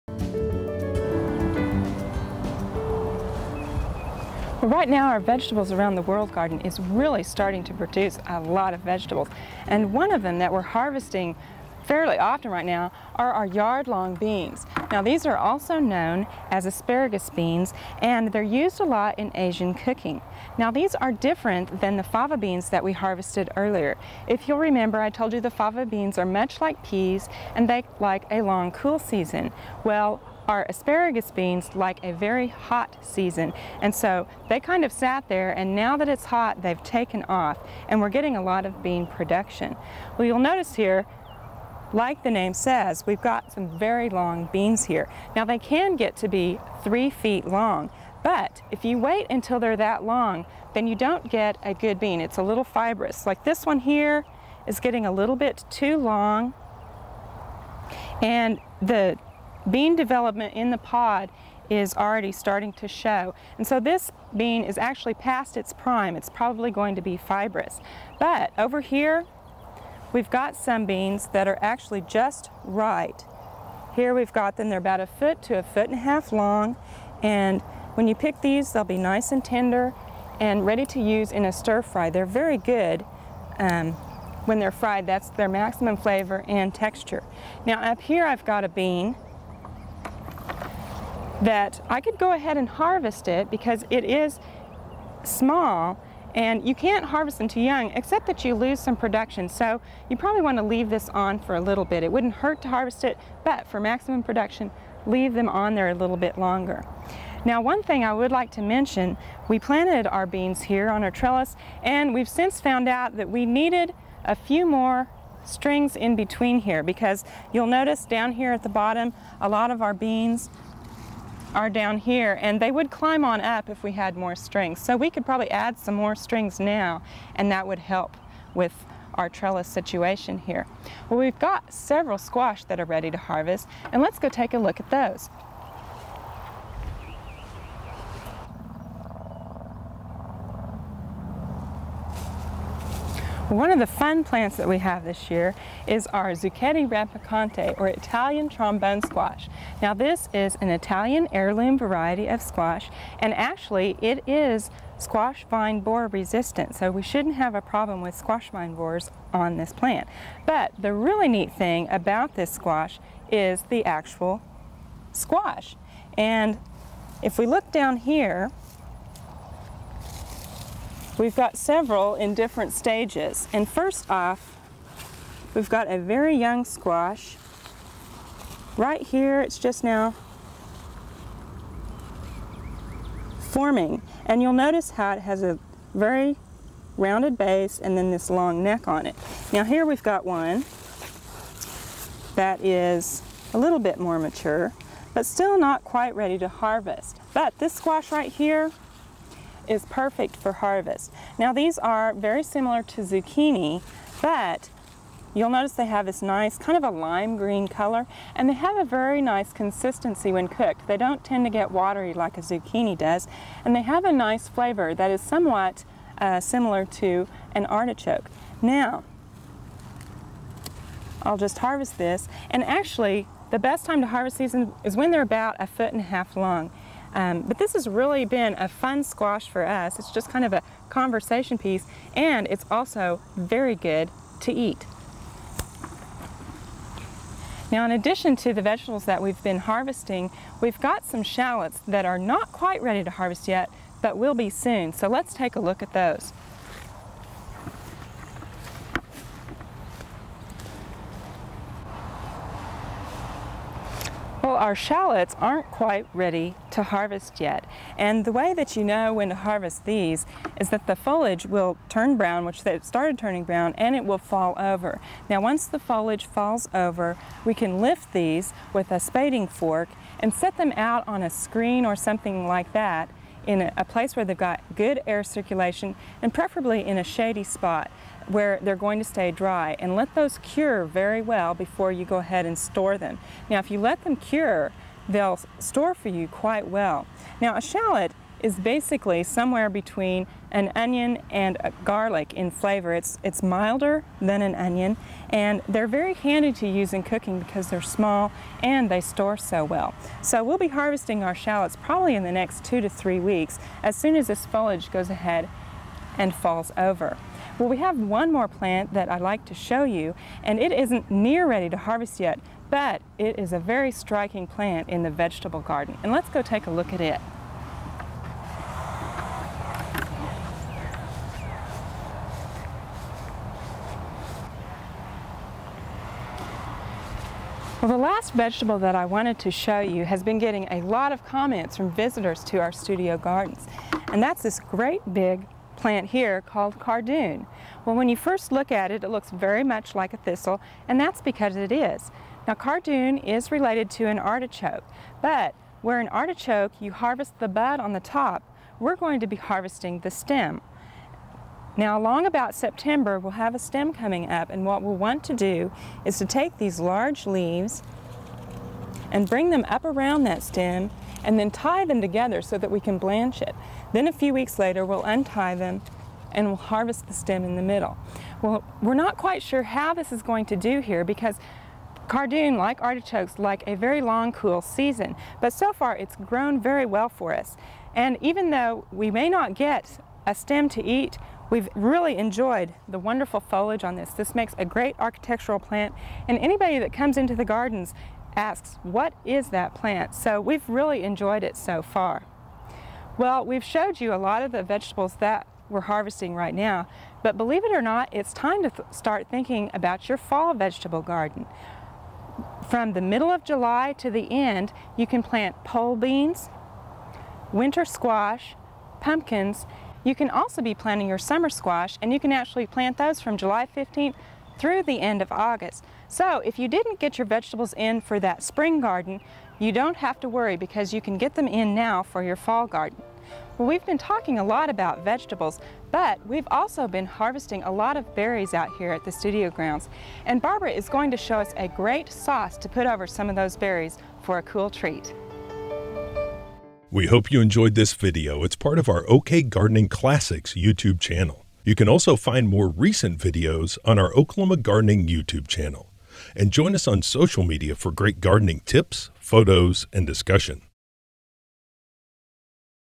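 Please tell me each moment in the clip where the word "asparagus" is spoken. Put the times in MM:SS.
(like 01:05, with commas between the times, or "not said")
00:16, 00:30.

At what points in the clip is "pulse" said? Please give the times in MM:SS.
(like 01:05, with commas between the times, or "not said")
not said.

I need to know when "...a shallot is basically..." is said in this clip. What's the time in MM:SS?
04:47.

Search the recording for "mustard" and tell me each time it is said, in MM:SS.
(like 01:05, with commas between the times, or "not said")
not said.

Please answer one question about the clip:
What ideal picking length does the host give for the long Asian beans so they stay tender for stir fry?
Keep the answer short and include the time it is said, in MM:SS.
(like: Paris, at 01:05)
a foot to a foot and a half, at 01:14.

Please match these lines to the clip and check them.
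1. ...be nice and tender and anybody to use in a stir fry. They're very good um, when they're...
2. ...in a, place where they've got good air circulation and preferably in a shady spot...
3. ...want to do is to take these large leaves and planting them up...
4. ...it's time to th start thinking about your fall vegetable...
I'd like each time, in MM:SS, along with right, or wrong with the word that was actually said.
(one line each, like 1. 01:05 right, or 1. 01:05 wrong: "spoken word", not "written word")
1. 01:18 wrong: "ready", not "anybody"
2. 04:33 right
3. 05:54 wrong: "bring", not "planting"
4. 06:38 right.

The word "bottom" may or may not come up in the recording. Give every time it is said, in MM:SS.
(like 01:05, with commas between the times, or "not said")
01:58.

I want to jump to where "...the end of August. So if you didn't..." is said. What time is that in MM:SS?
06:54.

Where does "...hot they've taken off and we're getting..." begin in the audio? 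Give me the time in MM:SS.
00:36.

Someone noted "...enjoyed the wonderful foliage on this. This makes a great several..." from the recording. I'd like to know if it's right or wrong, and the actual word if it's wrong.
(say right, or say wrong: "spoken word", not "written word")
wrong: "architectural", not "several".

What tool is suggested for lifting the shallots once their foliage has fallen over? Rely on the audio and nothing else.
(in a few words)
spading fork.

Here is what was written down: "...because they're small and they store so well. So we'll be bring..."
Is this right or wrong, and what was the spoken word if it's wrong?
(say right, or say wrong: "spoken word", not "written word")
wrong: "harvesting", not "bring".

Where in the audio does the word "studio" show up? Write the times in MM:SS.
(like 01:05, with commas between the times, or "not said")
05:32, 07:09.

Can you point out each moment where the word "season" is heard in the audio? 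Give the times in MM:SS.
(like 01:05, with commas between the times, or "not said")
00:28, 00:33, 06:14.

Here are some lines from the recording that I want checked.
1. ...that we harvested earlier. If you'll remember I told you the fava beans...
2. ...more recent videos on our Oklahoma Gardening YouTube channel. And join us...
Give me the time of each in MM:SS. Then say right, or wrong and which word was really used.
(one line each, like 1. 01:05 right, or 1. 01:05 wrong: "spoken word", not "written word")
1. 00:22 right
2. 07:22 right.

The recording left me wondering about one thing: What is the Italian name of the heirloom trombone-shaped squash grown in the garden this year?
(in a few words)
Zucchetti rampicante.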